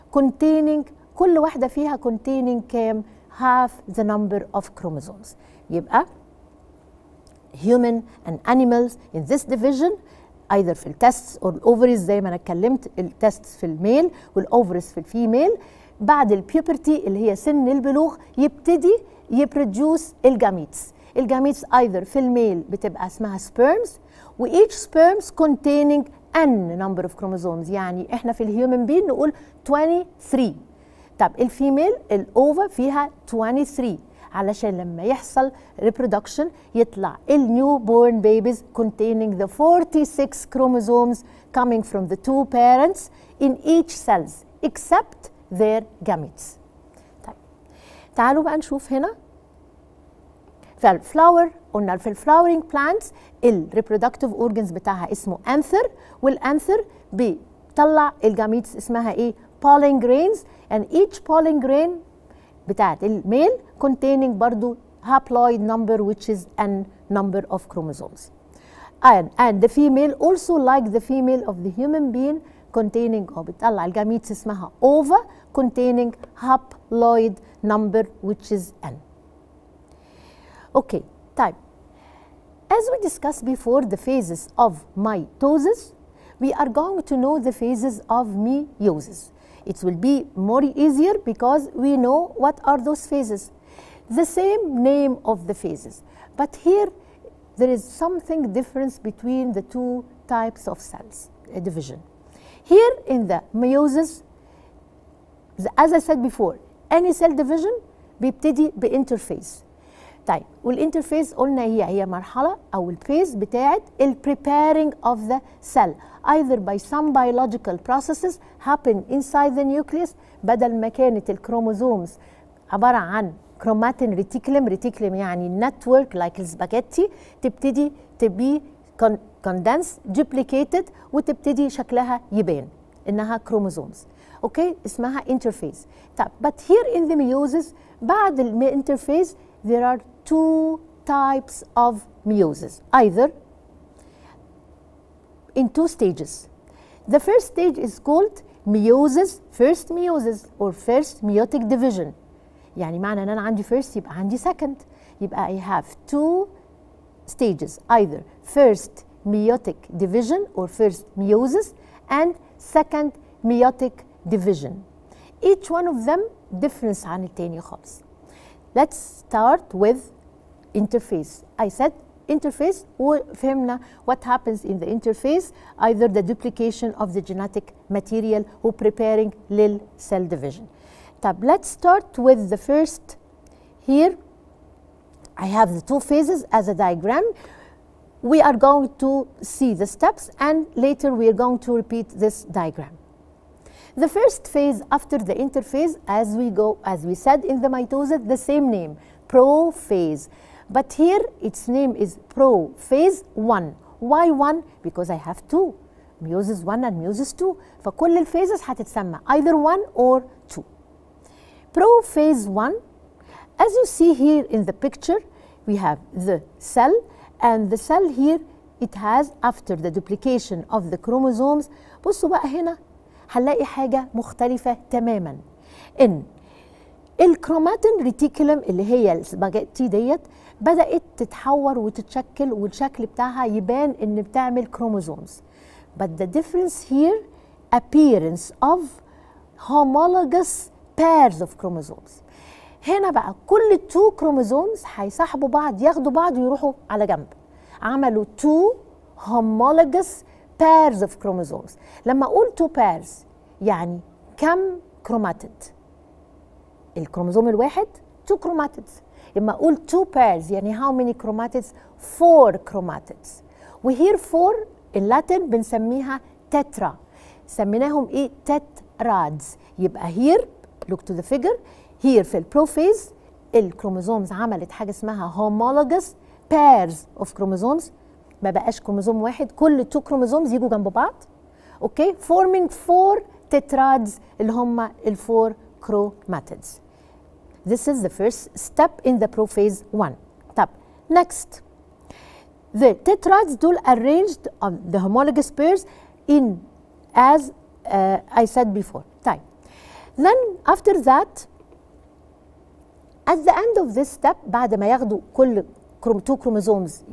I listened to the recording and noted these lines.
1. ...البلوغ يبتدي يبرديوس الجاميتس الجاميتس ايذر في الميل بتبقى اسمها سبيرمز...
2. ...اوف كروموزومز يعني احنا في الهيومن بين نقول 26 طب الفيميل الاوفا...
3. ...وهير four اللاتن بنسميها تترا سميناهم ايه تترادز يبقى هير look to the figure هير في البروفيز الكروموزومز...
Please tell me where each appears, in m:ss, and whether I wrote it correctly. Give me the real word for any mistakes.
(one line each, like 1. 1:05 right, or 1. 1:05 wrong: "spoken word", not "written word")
1. 0:17 right
2. 0:27 wrong: "23", not "26"
3. 4:23 right.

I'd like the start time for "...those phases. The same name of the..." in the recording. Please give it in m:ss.
1:32.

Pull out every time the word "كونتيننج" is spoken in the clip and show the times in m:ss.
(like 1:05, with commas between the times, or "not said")
0:25, 0:38.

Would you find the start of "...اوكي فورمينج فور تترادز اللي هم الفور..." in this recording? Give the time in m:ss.
4:41.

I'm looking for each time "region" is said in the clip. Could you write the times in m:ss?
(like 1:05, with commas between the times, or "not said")
not said.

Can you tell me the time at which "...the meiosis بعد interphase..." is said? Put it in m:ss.
2:17.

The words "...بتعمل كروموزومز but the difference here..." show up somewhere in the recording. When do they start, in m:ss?
3:54.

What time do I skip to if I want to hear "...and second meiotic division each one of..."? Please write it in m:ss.
2:42.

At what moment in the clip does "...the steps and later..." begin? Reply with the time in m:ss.
3:09.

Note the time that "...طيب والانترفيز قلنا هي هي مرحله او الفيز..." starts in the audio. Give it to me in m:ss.
1:50.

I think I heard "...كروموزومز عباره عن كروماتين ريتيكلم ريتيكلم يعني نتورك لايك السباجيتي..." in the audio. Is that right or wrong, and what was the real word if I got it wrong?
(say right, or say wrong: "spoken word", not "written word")
wrong: "الكروموزومز", not "كروموزومز".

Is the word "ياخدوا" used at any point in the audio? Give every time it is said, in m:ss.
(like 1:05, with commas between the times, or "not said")
4:05, 5:04.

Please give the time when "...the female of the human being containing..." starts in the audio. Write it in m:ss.
1:10.